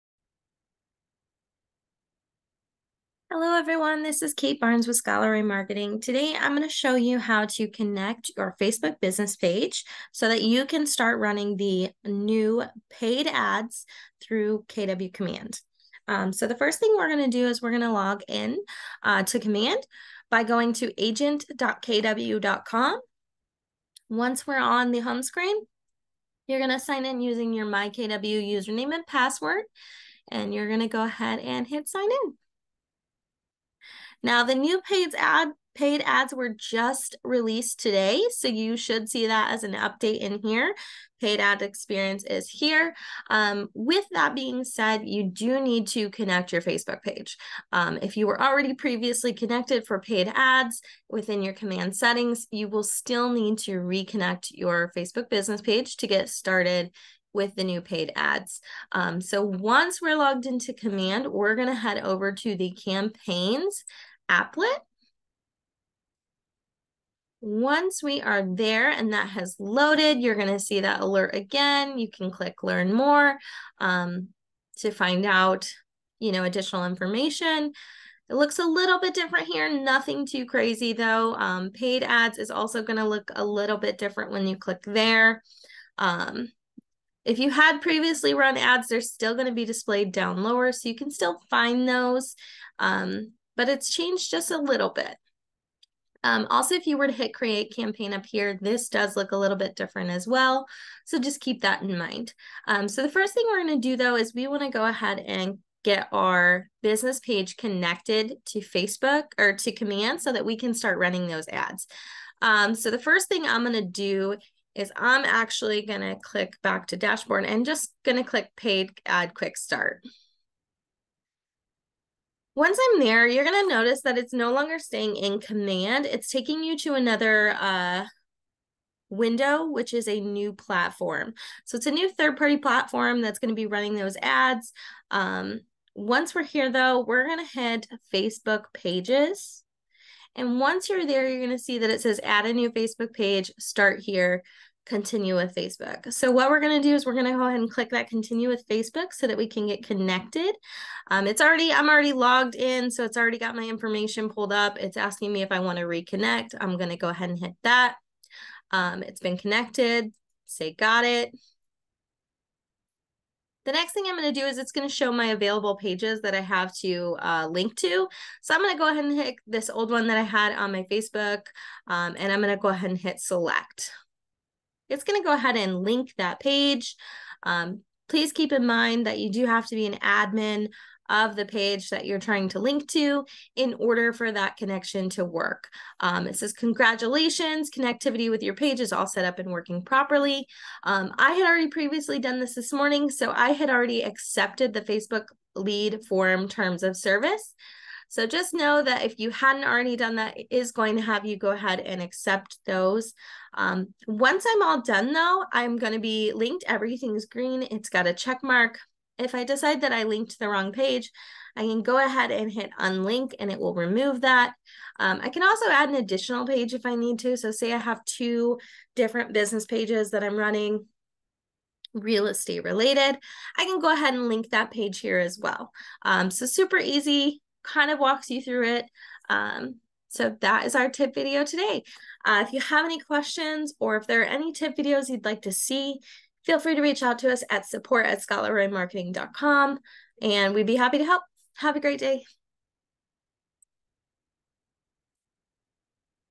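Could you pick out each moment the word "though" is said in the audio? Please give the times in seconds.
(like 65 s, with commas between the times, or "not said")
80 s, 103 s, 136 s, 205 s.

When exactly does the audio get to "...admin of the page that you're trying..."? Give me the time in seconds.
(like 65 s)
179 s.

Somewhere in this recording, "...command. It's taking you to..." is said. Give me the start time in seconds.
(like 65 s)
125 s.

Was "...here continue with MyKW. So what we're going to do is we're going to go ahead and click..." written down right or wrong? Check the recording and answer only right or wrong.
wrong.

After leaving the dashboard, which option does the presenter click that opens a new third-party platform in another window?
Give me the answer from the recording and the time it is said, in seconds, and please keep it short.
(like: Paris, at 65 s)
Paid ad quick start, at 118 s.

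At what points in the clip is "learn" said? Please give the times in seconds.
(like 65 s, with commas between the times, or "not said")
72 s.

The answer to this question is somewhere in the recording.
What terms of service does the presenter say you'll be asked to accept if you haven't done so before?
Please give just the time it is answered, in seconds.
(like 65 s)
194 s.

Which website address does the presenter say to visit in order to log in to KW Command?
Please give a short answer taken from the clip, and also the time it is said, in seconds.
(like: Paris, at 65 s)
agent.kw.com, at 21 s.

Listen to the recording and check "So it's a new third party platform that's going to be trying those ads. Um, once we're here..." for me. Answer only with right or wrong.
wrong.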